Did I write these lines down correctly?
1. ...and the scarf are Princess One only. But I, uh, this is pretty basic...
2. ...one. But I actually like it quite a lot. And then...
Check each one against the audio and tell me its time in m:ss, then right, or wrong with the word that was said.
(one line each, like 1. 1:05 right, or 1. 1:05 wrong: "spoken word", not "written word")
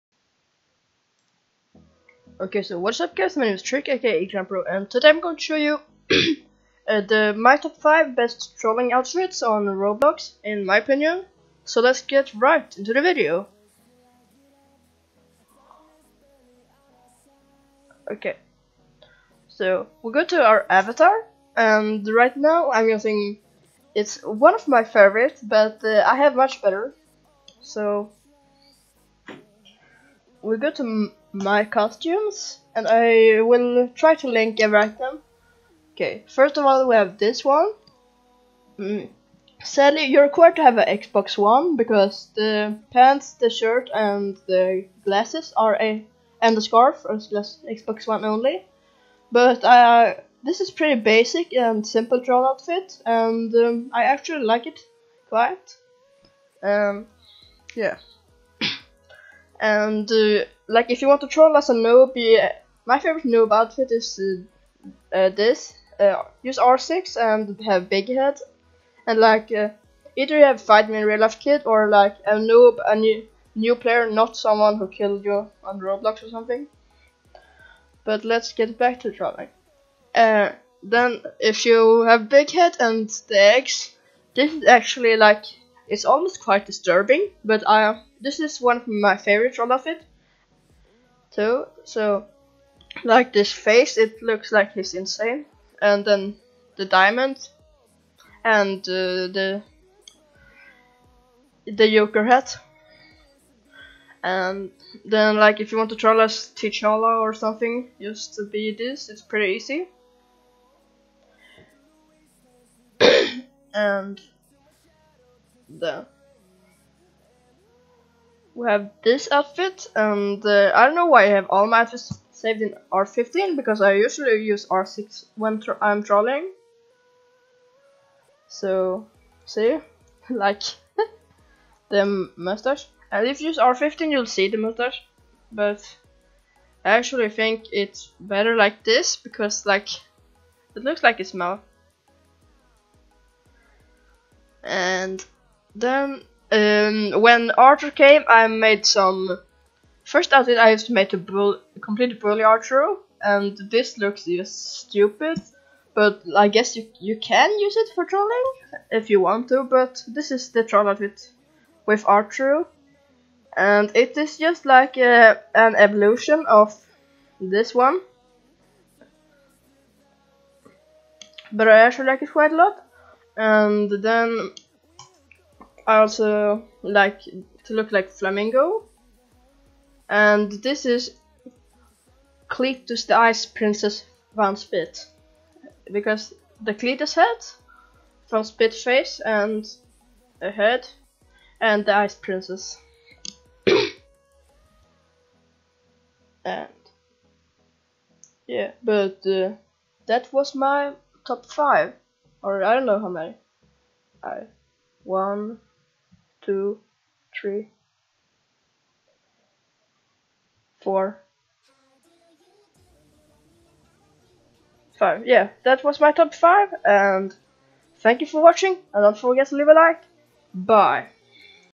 1. 0:46 wrong: "Xbox", not "Princess"
2. 2:47 right.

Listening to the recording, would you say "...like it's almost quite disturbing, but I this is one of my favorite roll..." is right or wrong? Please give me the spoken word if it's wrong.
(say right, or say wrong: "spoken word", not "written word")
right.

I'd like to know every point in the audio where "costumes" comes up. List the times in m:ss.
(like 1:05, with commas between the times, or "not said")
0:31.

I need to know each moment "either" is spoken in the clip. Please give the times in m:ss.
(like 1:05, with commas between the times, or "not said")
1:09.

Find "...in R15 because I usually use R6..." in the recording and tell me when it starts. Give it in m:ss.
2:02.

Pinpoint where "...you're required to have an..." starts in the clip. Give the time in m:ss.
0:40.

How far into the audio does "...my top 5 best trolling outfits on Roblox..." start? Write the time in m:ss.
0:07.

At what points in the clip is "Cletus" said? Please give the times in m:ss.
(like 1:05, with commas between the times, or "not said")
3:02, 3:06.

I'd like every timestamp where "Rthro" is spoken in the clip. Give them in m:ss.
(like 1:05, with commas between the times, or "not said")
2:27, 2:32, 2:42.